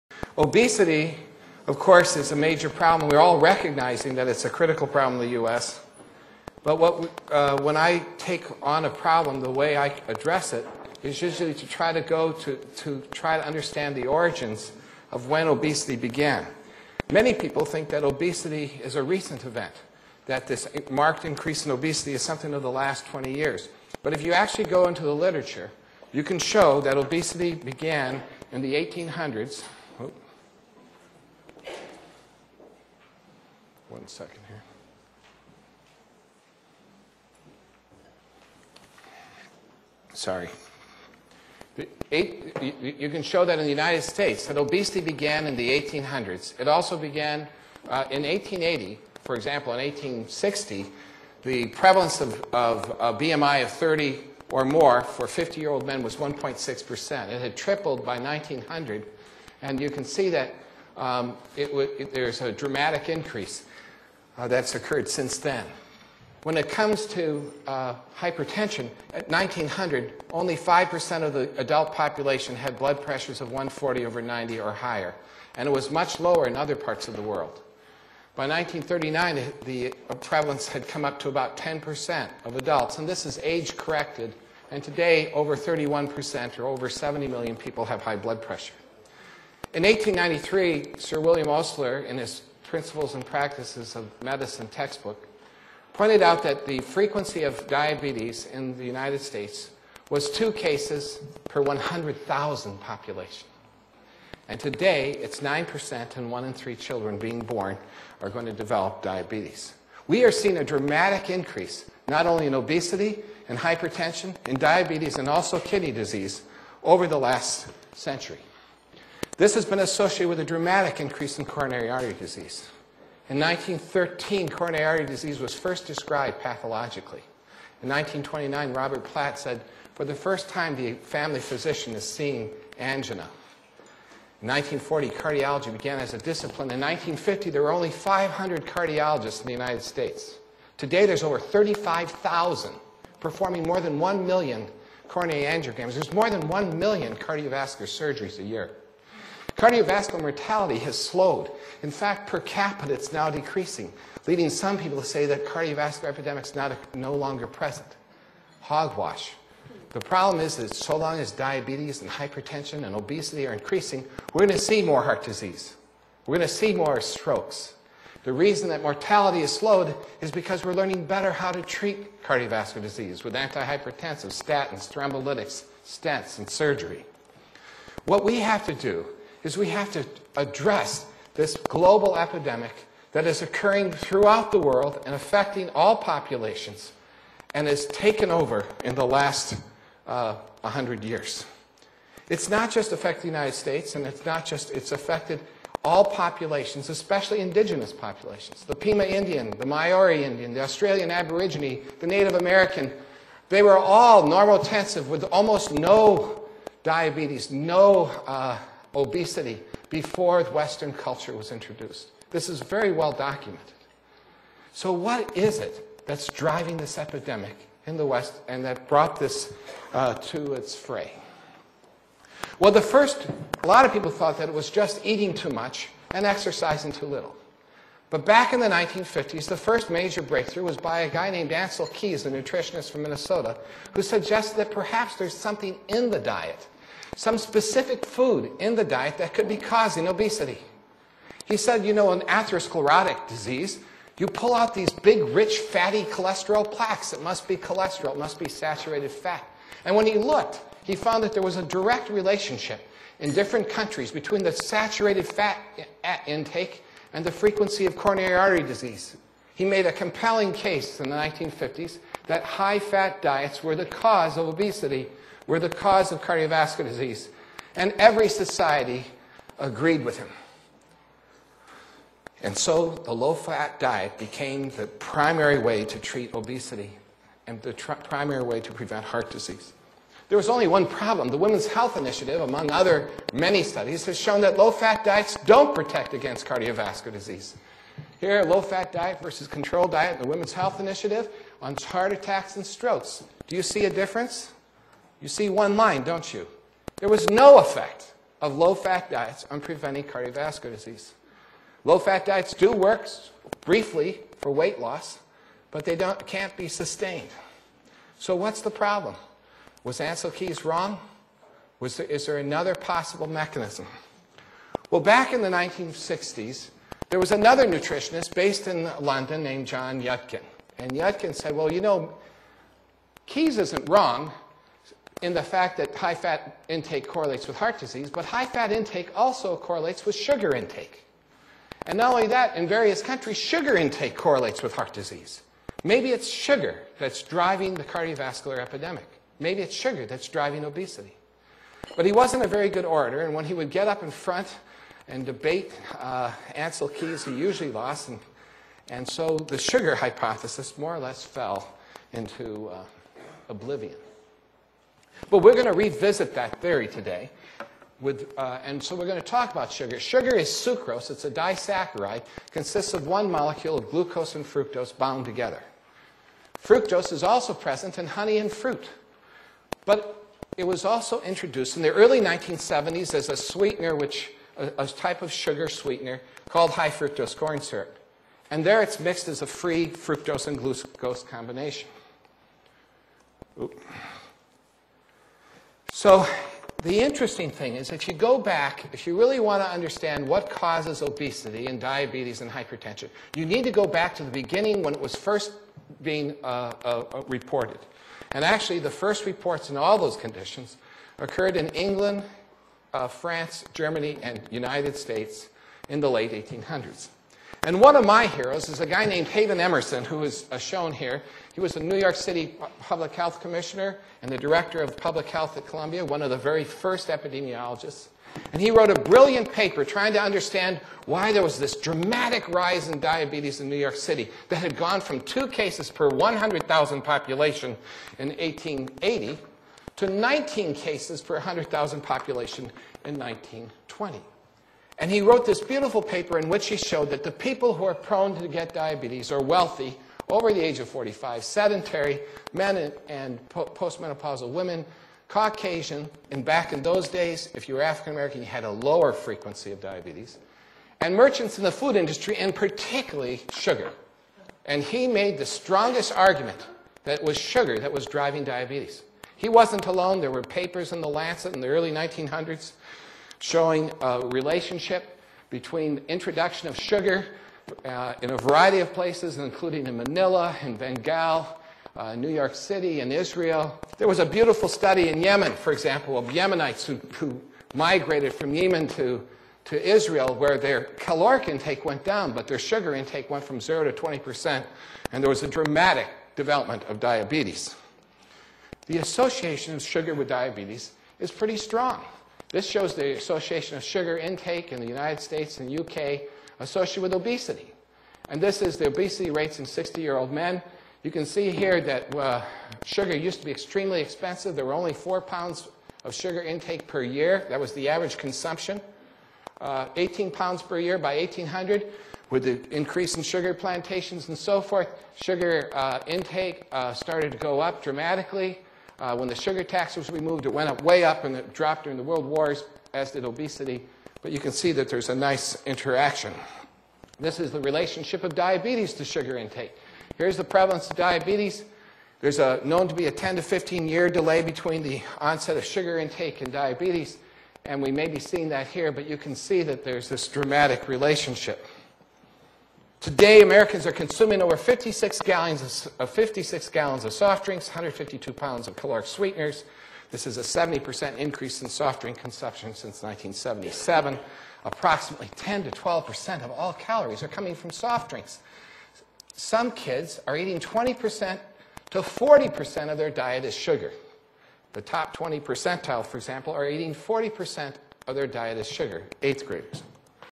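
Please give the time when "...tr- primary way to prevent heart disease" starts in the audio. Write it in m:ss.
4:37.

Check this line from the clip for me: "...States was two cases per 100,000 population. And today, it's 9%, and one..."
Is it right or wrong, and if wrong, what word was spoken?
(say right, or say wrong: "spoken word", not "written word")
right.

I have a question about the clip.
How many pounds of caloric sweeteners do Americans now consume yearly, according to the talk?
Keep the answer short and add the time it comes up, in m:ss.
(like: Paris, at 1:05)
152 pounds, at 9:07.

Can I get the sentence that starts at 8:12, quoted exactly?
This shows the association of sugar intake in the United States and UK associated with obesity.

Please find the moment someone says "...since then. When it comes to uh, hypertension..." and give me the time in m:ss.
1:05.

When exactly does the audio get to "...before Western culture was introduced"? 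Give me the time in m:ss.
3:29.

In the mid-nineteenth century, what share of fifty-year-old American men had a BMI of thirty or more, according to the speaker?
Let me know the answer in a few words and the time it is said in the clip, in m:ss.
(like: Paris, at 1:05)
1.6%, at 0:56.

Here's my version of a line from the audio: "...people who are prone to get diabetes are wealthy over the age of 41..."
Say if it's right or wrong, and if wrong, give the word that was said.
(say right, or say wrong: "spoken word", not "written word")
wrong: "45", not "41".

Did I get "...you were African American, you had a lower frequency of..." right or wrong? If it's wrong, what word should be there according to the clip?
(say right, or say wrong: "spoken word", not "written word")
right.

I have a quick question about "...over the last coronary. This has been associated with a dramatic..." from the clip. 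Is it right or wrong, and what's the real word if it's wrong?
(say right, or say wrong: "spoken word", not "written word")
wrong: "century", not "coronary".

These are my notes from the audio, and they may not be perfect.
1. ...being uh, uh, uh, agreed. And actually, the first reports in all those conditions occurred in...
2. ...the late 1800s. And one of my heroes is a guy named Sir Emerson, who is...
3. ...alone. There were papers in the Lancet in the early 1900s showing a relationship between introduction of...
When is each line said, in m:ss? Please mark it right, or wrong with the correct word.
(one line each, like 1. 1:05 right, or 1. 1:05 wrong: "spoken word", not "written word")
1. 6:36 wrong: "reported", not "agreed"
2. 6:45 wrong: "Haven", not "Sir"
3. 7:39 right.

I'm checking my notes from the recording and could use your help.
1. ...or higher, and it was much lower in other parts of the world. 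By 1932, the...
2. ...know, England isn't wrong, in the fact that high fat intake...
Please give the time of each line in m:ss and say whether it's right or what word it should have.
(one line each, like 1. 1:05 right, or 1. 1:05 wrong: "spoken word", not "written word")
1. 1:14 wrong: "1939", not "1932"
2. 5:21 wrong: "Keys", not "England".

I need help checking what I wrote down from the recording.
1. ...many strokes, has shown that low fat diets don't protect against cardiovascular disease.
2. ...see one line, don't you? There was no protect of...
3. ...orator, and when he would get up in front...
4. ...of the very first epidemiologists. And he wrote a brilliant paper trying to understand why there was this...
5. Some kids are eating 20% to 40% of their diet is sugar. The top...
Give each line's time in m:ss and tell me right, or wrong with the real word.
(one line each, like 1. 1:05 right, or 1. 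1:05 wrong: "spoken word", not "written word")
1. 4:43 wrong: "studies", not "strokes"
2. 4:55 wrong: "effect", not "protect"
3. 5:42 right
4. 6:56 right
5. 9:19 right.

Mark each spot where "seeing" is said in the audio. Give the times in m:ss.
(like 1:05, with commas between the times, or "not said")
1:50, 2:12, 8:58.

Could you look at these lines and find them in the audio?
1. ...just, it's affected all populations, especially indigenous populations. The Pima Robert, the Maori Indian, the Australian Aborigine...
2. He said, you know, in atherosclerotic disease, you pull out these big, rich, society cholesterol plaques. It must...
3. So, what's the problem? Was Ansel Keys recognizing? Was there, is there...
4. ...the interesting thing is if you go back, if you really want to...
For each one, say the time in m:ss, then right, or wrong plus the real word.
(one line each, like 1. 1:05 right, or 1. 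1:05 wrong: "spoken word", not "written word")
1. 3:14 wrong: "Indian", not "Robert"
2. 4:01 wrong: "fatty", not "society"
3. 5:08 wrong: "wrong", not "recognizing"
4. 6:26 right.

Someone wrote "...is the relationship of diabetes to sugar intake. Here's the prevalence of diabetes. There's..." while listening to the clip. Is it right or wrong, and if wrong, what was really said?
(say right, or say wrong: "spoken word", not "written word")
right.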